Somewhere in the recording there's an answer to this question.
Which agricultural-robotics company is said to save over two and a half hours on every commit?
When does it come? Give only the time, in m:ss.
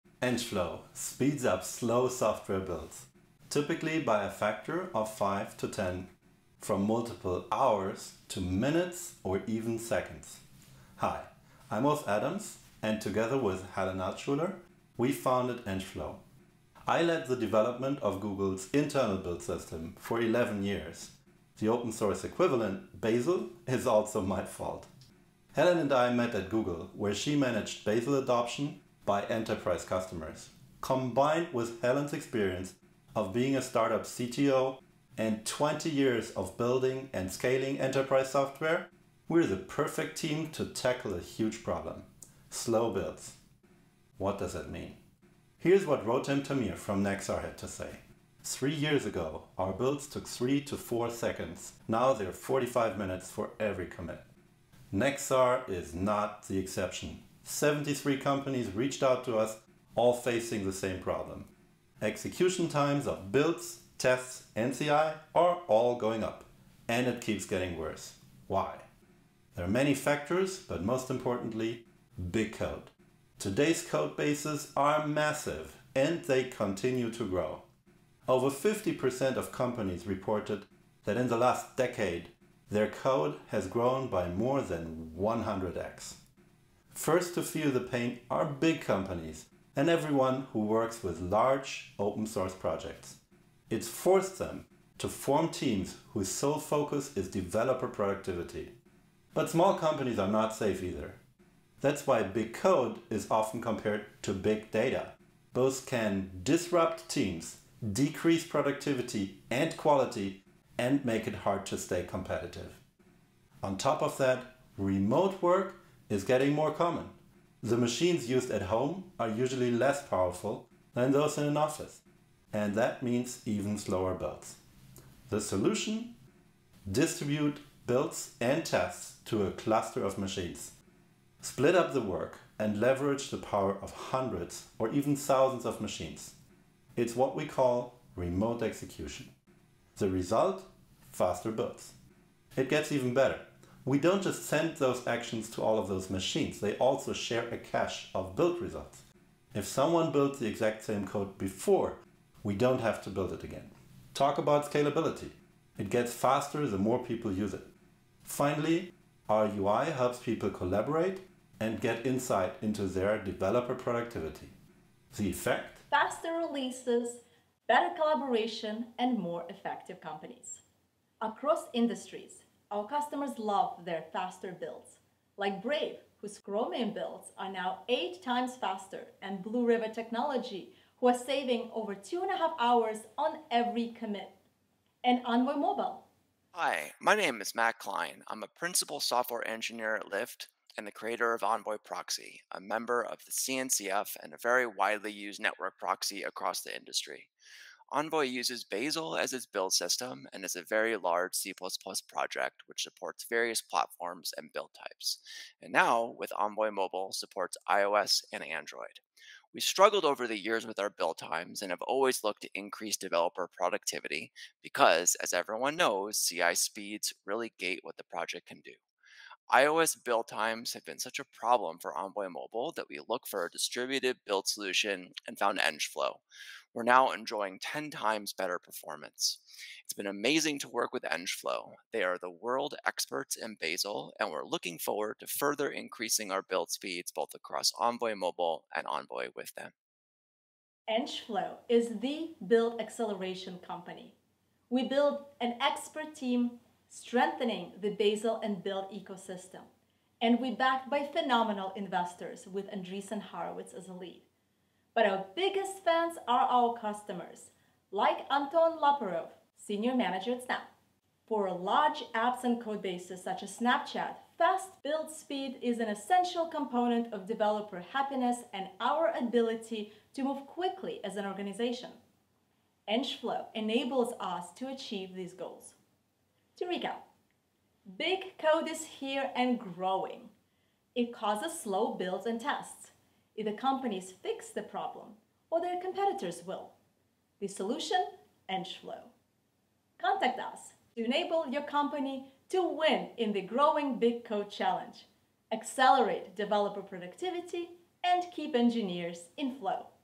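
2:59.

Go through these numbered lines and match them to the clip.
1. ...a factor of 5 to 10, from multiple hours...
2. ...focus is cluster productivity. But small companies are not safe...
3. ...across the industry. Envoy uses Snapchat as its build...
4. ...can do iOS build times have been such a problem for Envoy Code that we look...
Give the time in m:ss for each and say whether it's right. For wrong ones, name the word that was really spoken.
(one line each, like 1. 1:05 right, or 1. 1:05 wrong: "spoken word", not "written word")
1. 0:04 right
2. 1:36 wrong: "developer", not "cluster"
3. 3:16 wrong: "Bazel", not "Snapchat"
4. 3:38 wrong: "Mobile", not "Code".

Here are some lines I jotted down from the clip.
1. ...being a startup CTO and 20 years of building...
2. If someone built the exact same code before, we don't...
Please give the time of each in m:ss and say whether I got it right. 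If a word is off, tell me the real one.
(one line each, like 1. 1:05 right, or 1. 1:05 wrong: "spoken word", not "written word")
1. 0:33 right
2. 2:29 right.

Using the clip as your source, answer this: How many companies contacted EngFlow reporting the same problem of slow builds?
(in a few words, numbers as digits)
73.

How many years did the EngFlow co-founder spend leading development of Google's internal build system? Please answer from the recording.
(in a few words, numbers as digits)
11.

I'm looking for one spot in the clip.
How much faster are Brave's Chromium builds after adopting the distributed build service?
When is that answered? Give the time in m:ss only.
2:57.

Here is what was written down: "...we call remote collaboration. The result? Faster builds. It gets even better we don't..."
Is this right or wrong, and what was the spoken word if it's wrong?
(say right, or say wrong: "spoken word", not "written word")
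wrong: "execution", not "collaboration".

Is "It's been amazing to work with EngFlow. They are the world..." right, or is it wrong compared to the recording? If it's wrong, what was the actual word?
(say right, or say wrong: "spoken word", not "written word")
right.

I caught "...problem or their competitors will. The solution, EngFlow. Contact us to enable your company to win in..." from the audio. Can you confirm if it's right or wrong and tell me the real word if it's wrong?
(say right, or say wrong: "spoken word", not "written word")
right.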